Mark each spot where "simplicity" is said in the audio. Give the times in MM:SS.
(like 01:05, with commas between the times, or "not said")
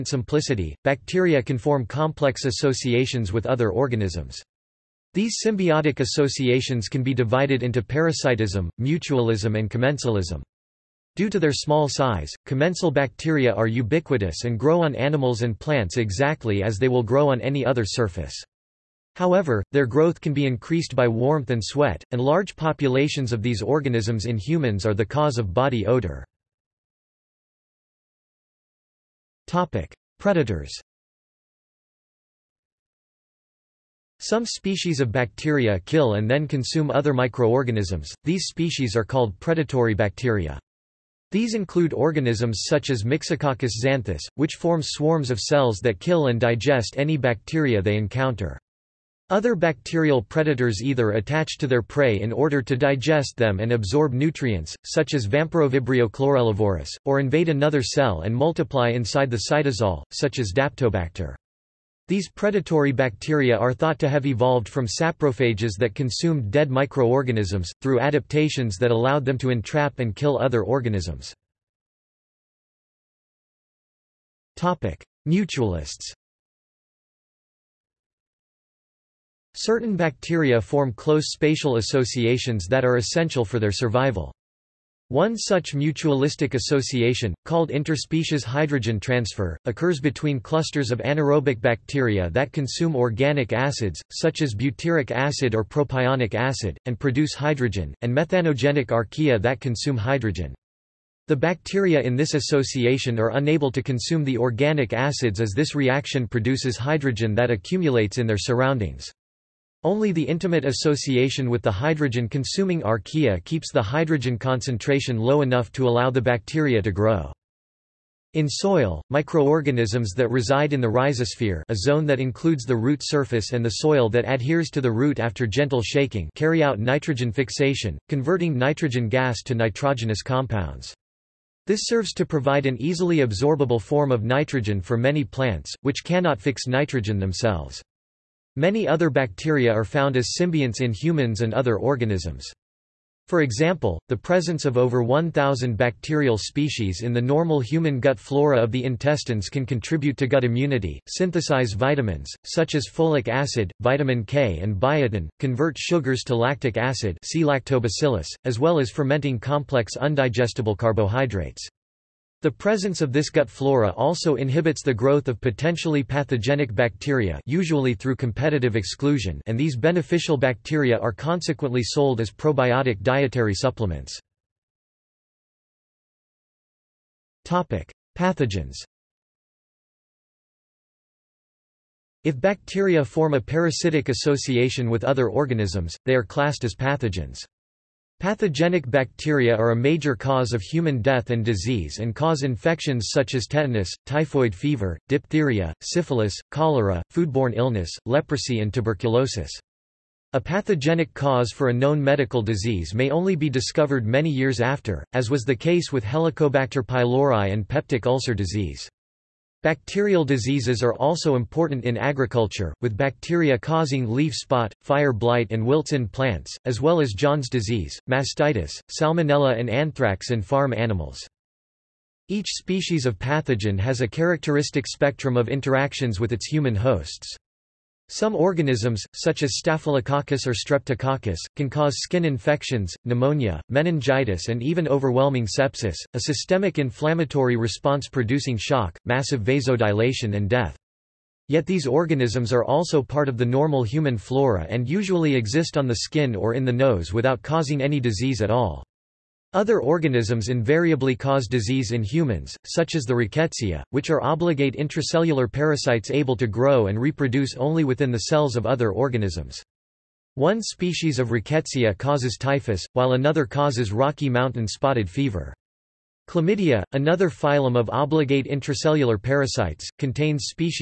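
00:00.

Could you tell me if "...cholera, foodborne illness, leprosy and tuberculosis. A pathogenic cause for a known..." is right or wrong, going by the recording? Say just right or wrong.
right.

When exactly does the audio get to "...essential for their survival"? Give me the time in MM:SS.
01:22.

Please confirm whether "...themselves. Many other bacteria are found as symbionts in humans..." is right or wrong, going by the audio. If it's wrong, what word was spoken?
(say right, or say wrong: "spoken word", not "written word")
right.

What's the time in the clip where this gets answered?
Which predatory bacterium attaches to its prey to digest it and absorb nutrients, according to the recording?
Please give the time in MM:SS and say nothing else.
00:55.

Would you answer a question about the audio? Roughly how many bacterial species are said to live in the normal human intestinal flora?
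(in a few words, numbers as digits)
over 1,000.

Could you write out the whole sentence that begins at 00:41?
These include organisms such as Myxococcus xanthus, which forms swarms of cells that kill and digest any bacteria they encounter.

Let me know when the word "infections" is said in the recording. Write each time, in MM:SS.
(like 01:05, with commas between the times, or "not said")
03:12, 03:52.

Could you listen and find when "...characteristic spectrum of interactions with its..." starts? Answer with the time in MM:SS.
03:44.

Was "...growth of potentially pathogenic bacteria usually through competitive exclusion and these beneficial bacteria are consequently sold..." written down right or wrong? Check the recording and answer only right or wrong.
right.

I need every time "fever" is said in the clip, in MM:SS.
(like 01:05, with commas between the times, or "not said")
03:14, 04:25.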